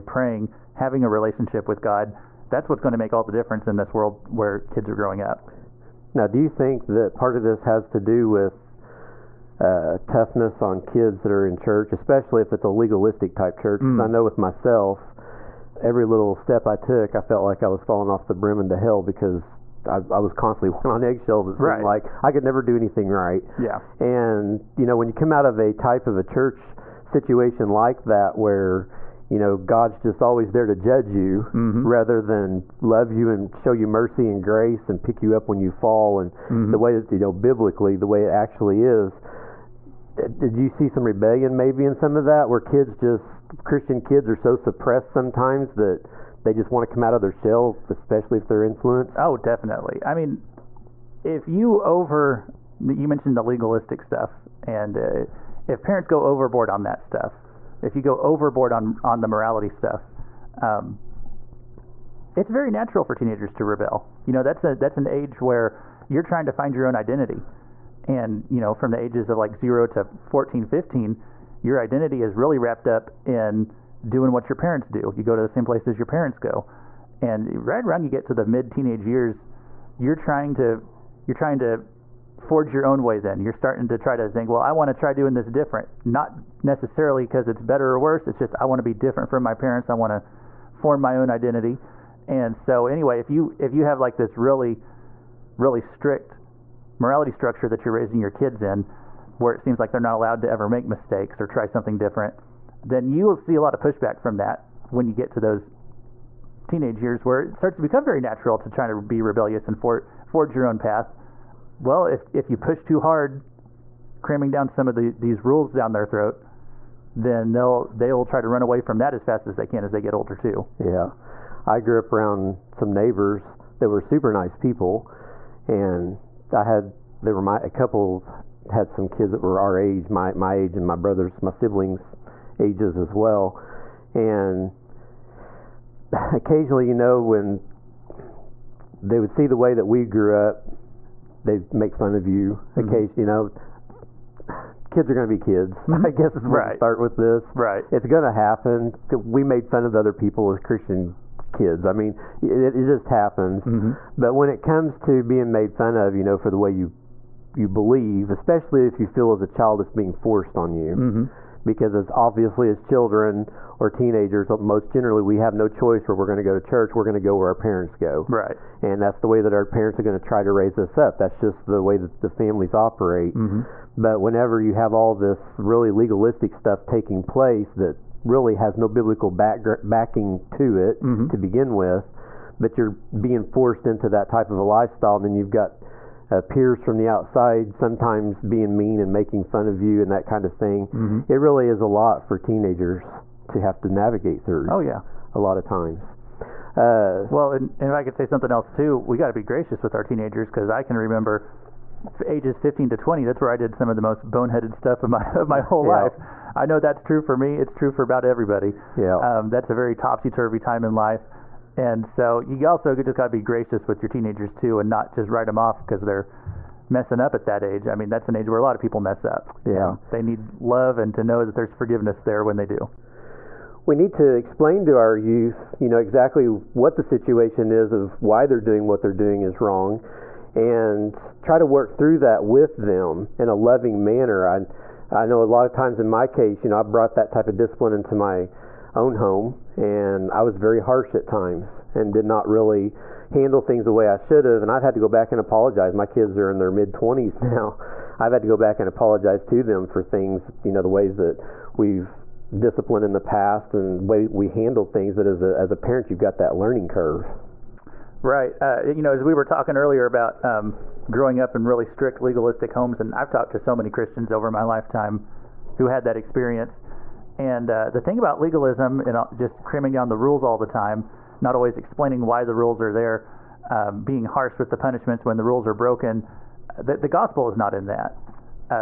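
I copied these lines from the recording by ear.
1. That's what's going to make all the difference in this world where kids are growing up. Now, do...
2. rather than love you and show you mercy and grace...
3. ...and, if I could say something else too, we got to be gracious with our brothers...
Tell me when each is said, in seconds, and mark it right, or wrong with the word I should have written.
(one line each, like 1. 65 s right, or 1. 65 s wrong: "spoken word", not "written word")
1. 2 s right
2. 31 s right
3. 197 s wrong: "teenagers", not "brothers".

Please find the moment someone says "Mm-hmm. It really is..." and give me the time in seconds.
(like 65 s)
190 s.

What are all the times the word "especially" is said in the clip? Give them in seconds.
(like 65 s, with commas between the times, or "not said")
11 s, 47 s, 158 s.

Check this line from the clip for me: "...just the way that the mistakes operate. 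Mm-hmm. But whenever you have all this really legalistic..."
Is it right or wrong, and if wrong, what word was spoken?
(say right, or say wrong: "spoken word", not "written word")
wrong: "families", not "mistakes".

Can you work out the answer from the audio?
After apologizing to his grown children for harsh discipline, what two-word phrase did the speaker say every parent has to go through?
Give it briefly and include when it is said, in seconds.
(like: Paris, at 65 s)
learning curve, at 256 s.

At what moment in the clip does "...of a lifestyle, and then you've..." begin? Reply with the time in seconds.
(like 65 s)
184 s.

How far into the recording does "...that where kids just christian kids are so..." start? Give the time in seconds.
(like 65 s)
42 s.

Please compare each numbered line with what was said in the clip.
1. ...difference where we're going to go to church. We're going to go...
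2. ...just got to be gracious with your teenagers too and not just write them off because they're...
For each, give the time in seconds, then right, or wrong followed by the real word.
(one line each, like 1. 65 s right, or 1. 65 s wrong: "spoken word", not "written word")
1. 165 s wrong: "choice", not "difference"
2. 212 s right.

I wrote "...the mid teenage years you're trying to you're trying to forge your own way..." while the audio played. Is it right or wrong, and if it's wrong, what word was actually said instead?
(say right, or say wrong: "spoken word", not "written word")
right.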